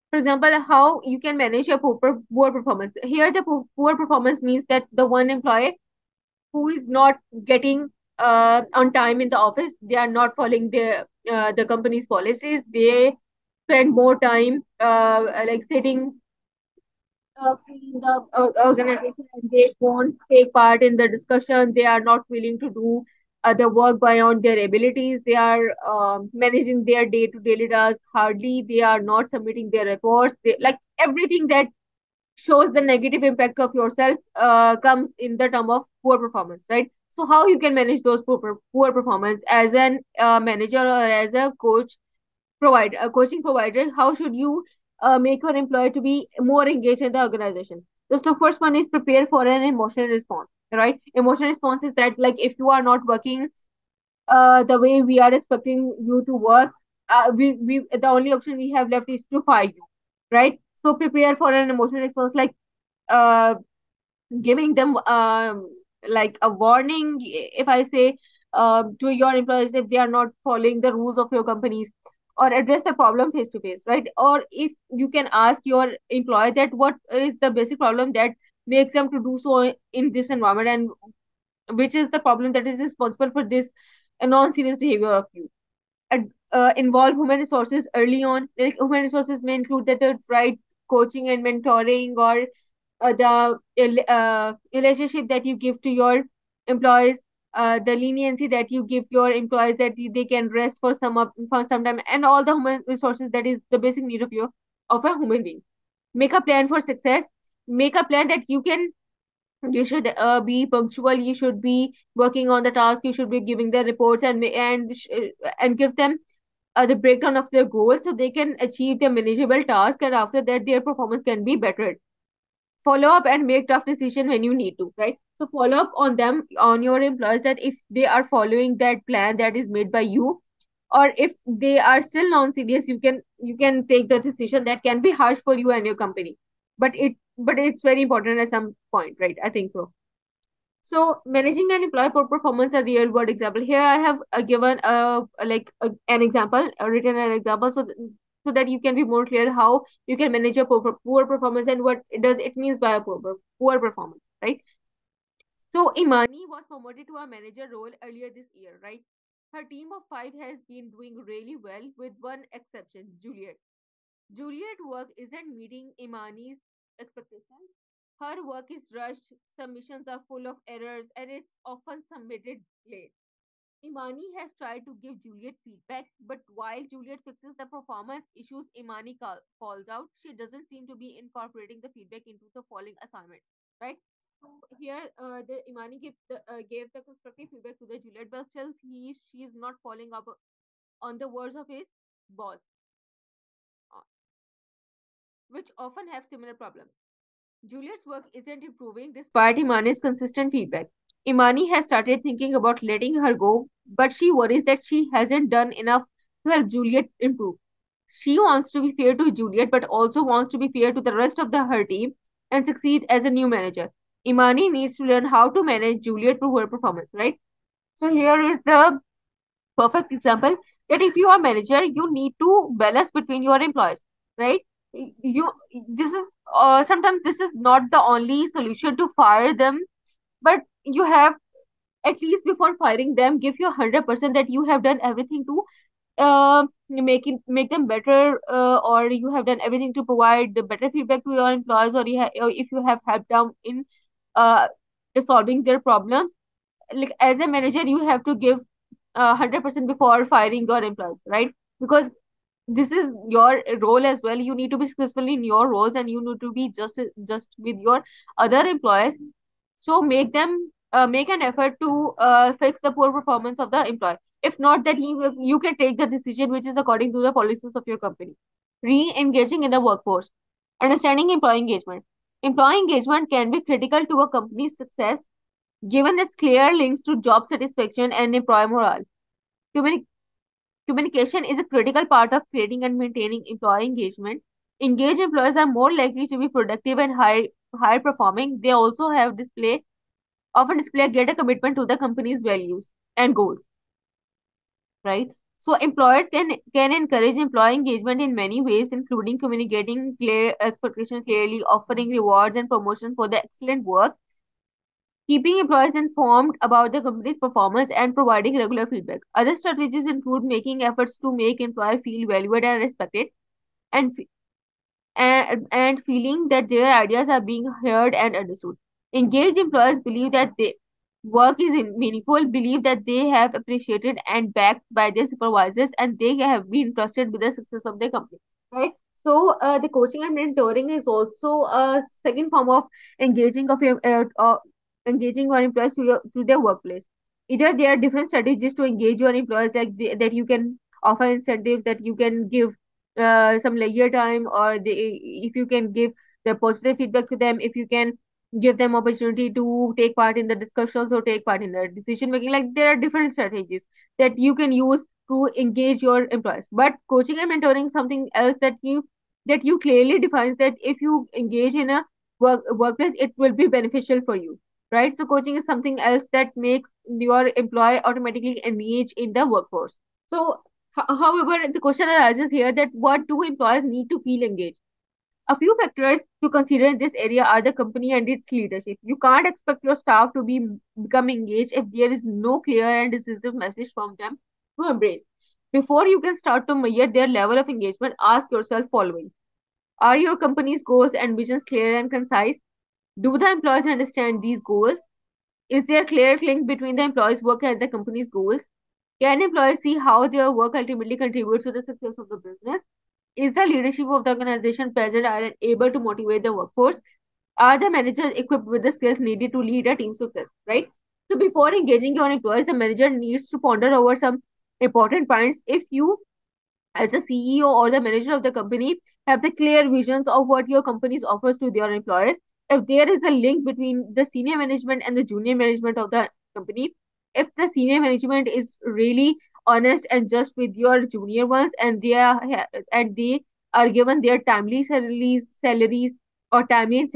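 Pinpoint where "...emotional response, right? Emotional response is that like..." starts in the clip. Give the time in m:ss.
0:49.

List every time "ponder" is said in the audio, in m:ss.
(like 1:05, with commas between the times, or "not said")
6:53.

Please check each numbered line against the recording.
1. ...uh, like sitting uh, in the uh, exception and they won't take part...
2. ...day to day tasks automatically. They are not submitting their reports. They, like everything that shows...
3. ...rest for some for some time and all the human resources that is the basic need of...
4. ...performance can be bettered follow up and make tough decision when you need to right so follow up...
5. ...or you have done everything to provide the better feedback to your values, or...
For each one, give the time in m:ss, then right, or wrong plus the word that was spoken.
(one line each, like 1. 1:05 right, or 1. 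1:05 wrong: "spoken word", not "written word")
1. 0:14 wrong: "organization", not "exception"
2. 0:27 wrong: "hardly", not "automatically"
3. 1:40 right
4. 2:00 right
5. 3:58 wrong: "employees", not "values".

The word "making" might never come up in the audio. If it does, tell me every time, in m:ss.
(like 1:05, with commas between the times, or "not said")
5:10, 5:52.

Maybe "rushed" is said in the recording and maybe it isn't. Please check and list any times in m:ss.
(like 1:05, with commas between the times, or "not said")
2:48.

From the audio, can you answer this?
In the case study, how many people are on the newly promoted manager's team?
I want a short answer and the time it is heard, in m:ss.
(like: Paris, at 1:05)
5, at 2:40.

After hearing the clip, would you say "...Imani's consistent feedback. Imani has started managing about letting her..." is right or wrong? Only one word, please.
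wrong.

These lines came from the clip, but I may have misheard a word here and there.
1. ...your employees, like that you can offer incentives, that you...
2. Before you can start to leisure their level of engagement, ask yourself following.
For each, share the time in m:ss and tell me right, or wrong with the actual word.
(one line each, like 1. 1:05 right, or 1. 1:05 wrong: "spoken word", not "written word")
1. 5:39 right
2. 6:25 wrong: "measure", not "leisure".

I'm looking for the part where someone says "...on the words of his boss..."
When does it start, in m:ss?
3:10.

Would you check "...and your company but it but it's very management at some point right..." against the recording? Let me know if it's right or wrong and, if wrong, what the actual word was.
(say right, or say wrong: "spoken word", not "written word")
wrong: "important", not "management".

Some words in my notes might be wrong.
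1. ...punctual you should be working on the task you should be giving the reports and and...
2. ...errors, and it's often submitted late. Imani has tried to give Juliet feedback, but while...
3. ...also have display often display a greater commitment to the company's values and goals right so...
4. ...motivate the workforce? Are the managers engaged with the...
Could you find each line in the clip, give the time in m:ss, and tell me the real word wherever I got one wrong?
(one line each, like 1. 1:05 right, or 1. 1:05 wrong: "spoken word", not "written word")
1. 1:50 right
2. 2:50 right
3. 4:48 right
4. 6:45 wrong: "equipped", not "engaged".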